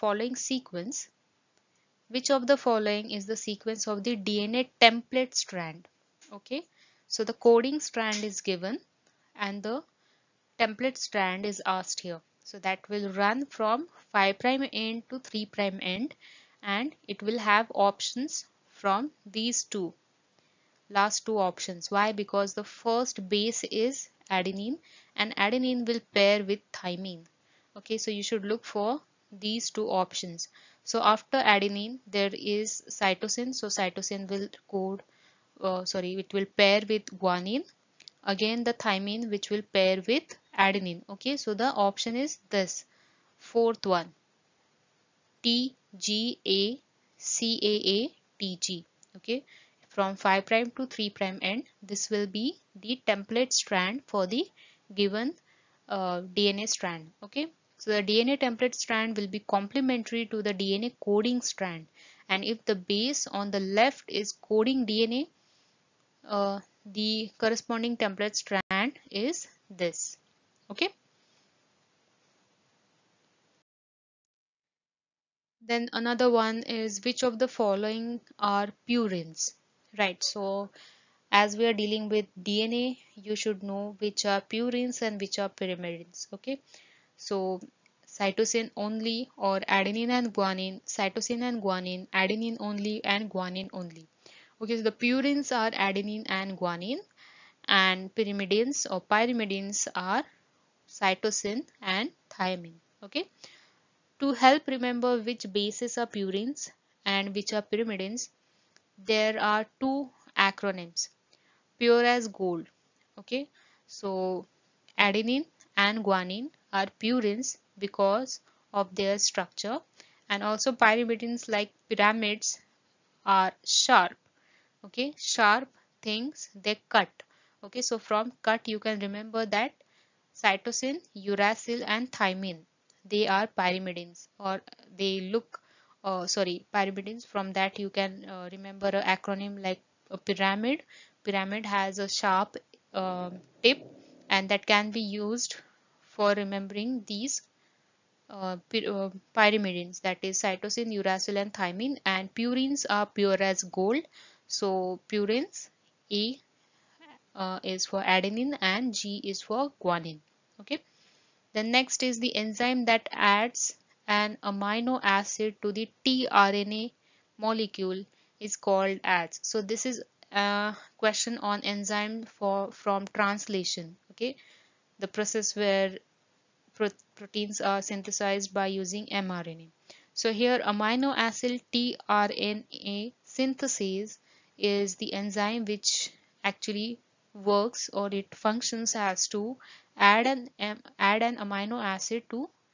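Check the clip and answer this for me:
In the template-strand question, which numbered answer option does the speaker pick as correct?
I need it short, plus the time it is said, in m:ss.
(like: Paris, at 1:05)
fourth, at 0:43.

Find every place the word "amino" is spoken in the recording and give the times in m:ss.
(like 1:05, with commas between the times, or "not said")
2:44, 3:00, 3:11.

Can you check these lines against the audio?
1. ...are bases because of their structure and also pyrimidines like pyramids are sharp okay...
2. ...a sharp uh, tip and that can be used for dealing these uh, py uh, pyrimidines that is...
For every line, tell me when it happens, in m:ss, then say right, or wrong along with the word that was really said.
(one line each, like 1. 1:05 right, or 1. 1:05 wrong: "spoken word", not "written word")
1. 1:56 wrong: "purines", not "bases"
2. 2:21 wrong: "remembering", not "dealing".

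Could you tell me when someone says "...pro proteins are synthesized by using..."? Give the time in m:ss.
2:56.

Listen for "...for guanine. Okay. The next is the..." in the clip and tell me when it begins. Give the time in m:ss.
2:39.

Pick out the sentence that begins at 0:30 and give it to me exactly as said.
So after adenine, there is cytosine.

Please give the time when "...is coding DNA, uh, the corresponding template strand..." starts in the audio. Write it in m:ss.
1:04.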